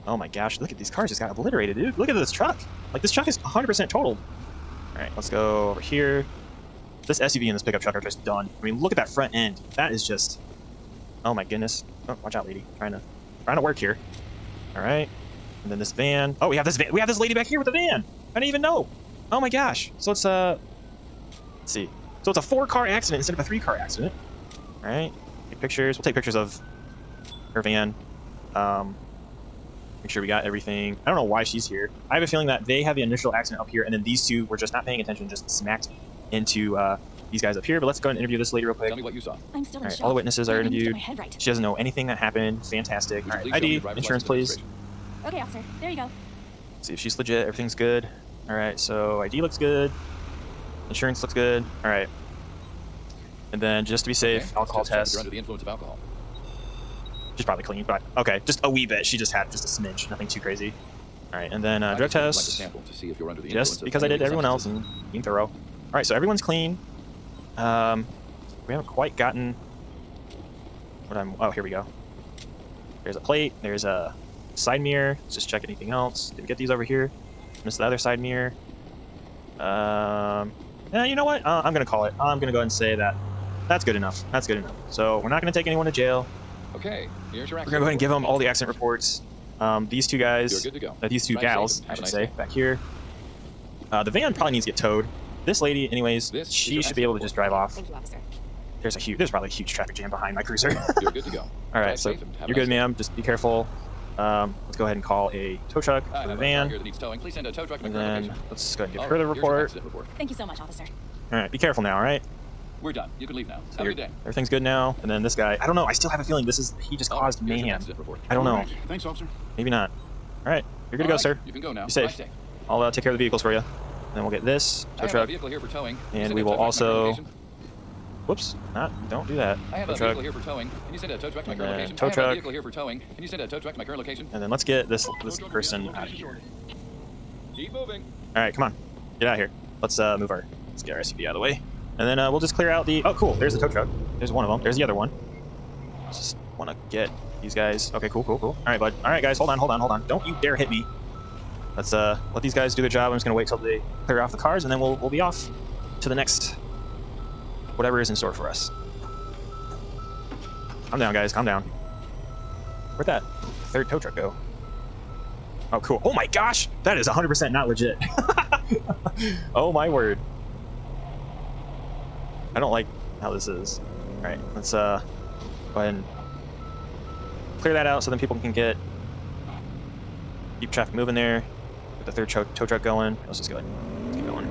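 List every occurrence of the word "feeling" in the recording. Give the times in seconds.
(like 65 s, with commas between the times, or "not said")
32 s, 116 s.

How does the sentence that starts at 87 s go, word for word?
We're gonna go ahead and give them all the accident reports.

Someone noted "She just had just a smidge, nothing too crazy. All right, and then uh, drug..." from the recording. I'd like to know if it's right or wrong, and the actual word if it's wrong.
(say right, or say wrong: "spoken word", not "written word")
right.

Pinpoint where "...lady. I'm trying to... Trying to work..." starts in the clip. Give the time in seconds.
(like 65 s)
12 s.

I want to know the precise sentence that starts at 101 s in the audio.
All right, drive so you're nice good, ma'am.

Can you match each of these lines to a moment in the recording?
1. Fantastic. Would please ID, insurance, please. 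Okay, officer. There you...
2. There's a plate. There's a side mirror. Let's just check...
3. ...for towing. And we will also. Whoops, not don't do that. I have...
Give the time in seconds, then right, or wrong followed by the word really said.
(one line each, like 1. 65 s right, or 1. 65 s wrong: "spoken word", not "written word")
1. 42 s right
2. 73 s right
3. 125 s right.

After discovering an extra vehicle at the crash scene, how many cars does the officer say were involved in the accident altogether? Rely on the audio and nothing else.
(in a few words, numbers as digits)
4.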